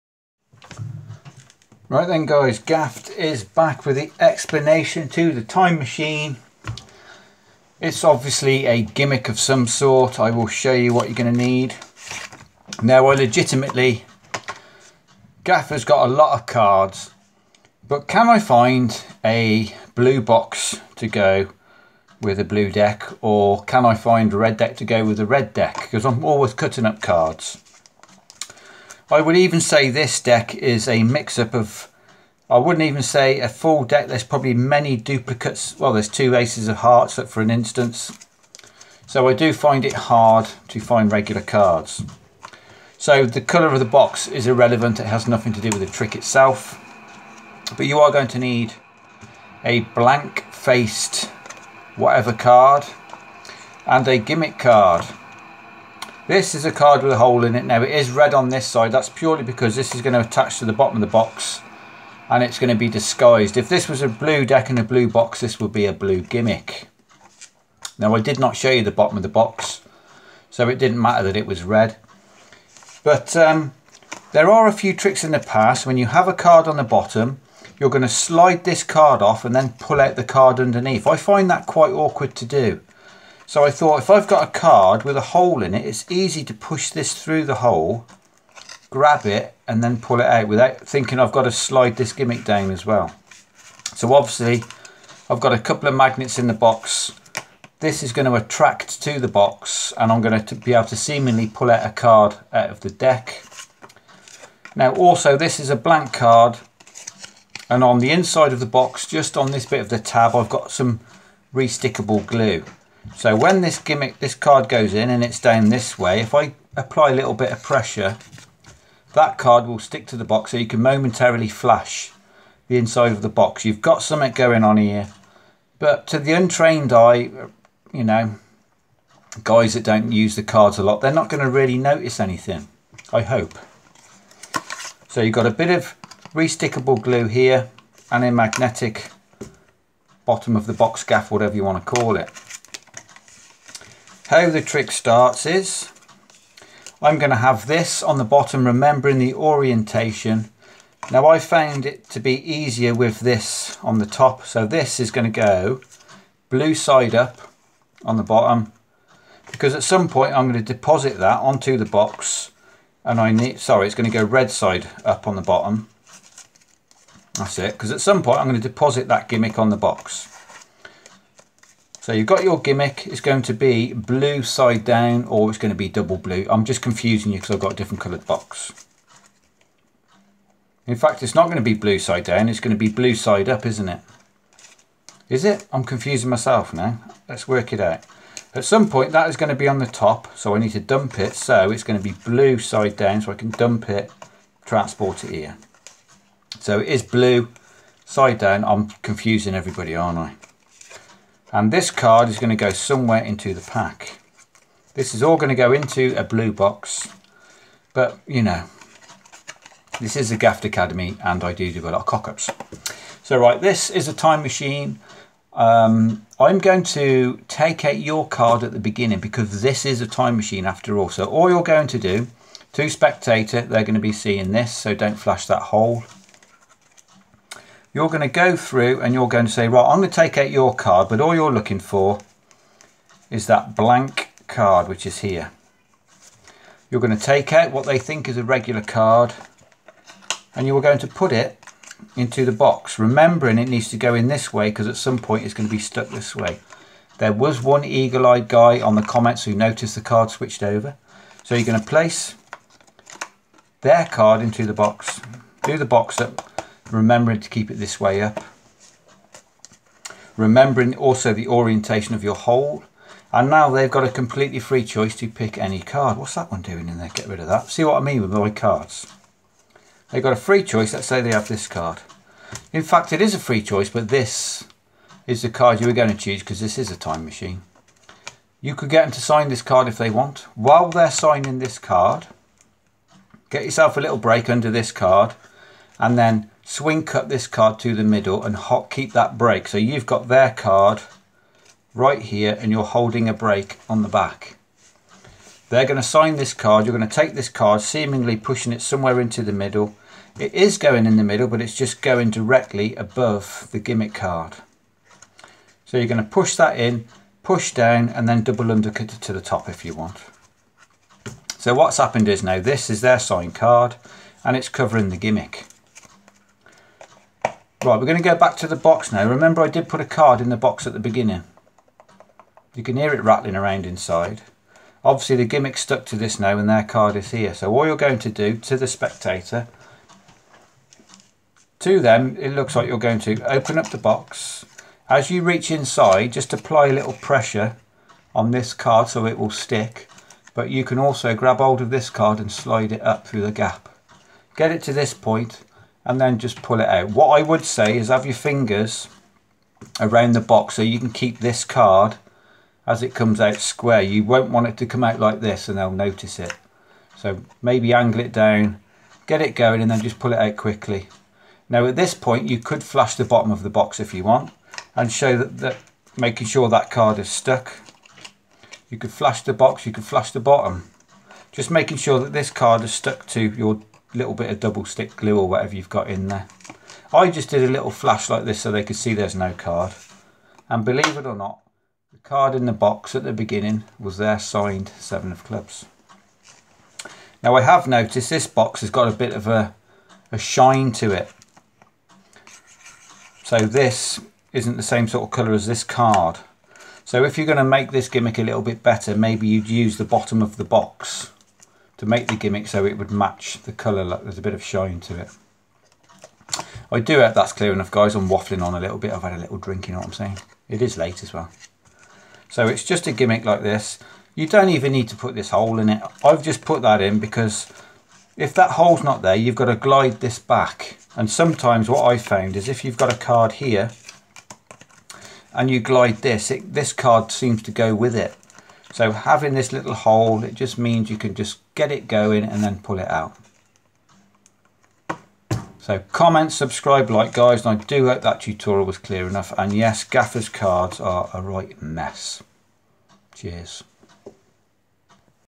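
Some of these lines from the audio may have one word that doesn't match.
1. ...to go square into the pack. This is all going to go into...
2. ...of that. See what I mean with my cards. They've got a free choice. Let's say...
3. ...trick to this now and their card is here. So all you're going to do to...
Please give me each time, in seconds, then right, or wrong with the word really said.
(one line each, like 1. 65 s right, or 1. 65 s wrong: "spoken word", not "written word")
1. 202 s wrong: "somewhere", not "square"
2. 267 s right
3. 325 s wrong: "stuck", not "trick".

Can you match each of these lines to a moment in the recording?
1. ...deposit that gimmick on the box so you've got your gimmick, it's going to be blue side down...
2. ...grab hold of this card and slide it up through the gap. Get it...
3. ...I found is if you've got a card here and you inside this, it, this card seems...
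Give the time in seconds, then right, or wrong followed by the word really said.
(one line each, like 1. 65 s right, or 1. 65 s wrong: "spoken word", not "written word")
1. 168 s right
2. 341 s right
3. 422 s wrong: "glide", not "inside".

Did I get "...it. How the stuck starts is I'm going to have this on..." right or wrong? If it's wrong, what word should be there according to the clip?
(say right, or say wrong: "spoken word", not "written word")
wrong: "trick", not "stuck".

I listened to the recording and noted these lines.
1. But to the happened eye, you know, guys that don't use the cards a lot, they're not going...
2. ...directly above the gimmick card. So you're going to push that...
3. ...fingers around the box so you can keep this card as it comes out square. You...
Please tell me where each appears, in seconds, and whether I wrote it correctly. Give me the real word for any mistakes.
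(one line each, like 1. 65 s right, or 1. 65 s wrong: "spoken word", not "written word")
1. 125 s wrong: "untrained", not "happened"
2. 302 s right
3. 348 s right.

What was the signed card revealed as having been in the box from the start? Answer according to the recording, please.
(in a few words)
Seven of Clubs.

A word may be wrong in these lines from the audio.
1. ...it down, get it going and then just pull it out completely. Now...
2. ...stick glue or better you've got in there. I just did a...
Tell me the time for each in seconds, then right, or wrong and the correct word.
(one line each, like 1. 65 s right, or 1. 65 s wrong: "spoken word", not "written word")
1. 358 s wrong: "quickly", not "completely"
2. 374 s wrong: "whatever", not "better".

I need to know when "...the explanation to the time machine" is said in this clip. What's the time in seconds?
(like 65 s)
3 s.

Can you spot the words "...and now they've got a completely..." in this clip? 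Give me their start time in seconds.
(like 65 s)
263 s.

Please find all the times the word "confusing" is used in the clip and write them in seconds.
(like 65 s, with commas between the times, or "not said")
176 s, 185 s, 199 s.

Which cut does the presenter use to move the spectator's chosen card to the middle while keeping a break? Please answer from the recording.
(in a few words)
Swing cut.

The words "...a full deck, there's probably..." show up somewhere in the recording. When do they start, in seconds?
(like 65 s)
33 s.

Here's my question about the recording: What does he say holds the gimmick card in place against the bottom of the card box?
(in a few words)
Magnets.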